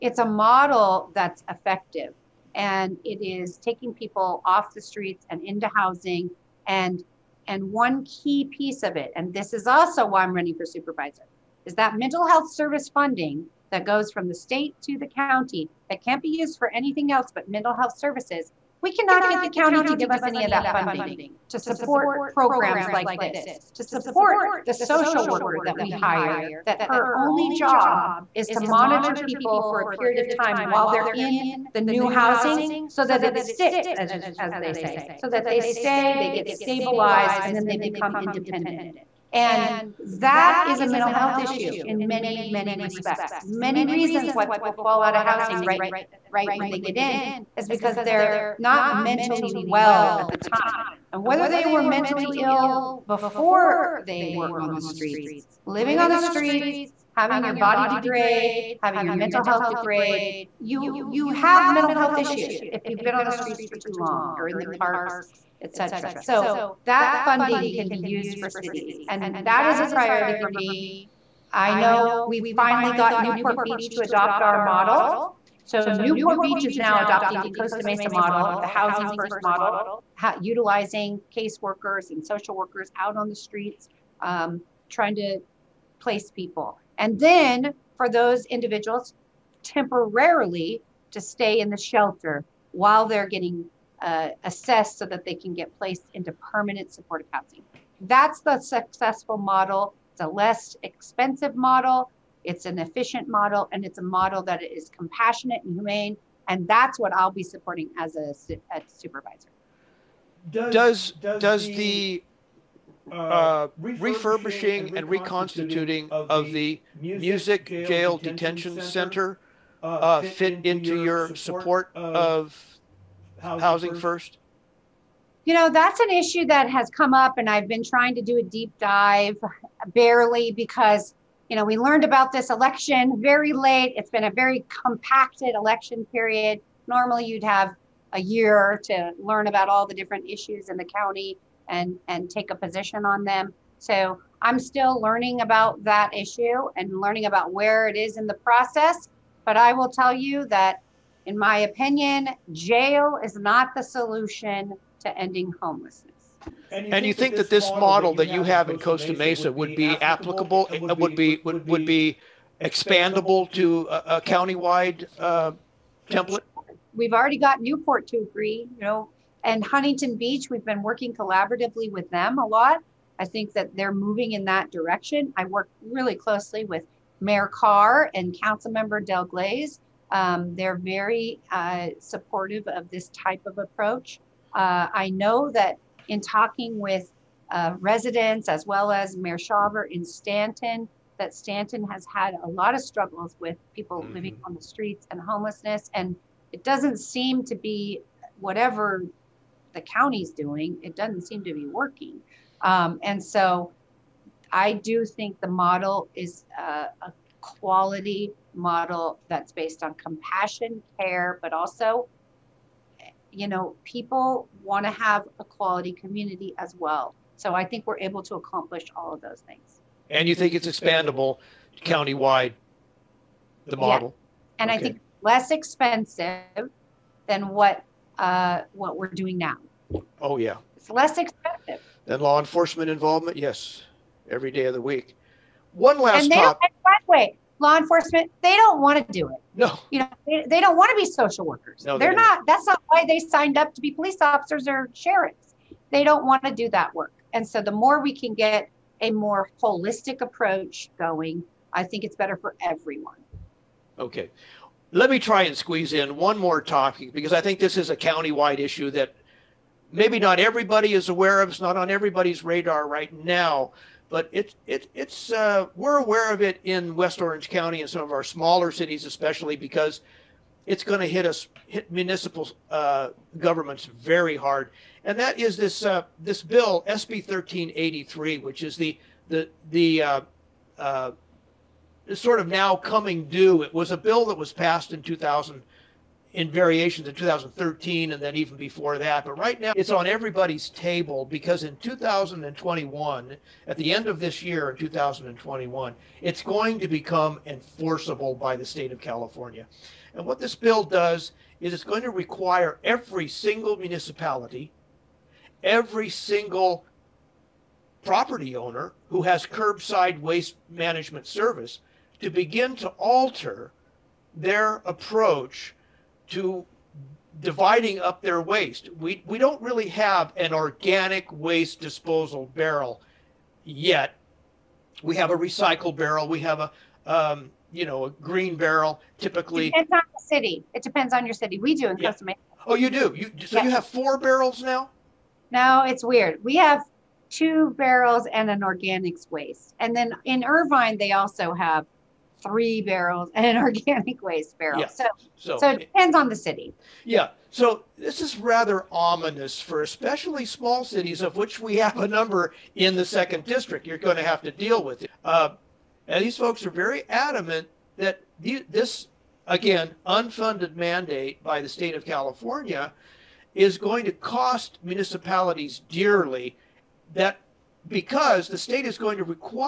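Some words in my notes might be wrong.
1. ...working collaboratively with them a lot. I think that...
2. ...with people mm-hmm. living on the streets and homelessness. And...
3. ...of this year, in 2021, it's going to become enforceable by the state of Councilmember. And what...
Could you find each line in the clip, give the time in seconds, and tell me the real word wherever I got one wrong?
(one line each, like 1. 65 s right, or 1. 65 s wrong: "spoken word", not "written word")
1. 170 s right
2. 193 s right
3. 294 s wrong: "California", not "Councilmember".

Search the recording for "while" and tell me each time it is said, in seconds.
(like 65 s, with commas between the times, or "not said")
30 s, 92 s.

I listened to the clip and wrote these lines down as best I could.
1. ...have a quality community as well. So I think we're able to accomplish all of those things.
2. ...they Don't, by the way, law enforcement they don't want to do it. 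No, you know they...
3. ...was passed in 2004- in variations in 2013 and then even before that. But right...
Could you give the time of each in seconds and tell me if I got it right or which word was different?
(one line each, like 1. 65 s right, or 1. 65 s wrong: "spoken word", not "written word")
1. 214 s right
2. 236 s right
3. 284 s wrong: "2000", not "2004".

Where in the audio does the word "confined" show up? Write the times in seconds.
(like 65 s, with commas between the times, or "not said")
not said.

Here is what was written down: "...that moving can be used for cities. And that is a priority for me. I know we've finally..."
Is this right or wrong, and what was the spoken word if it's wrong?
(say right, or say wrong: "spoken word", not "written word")
wrong: "funding", not "moving".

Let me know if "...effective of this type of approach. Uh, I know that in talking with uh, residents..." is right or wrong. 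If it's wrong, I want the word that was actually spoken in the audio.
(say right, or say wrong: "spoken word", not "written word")
wrong: "supportive", not "effective".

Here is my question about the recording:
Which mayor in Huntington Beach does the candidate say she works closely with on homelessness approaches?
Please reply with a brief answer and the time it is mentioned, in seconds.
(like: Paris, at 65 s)
Mayor Carr, at 177 s.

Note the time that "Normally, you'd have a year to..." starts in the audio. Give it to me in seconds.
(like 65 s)
136 s.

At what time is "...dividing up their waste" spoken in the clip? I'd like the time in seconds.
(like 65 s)
317 s.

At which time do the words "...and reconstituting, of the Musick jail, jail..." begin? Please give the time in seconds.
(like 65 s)
114 s.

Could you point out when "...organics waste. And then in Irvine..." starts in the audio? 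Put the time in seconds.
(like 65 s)
338 s.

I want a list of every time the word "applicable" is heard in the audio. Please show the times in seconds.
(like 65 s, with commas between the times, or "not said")
159 s.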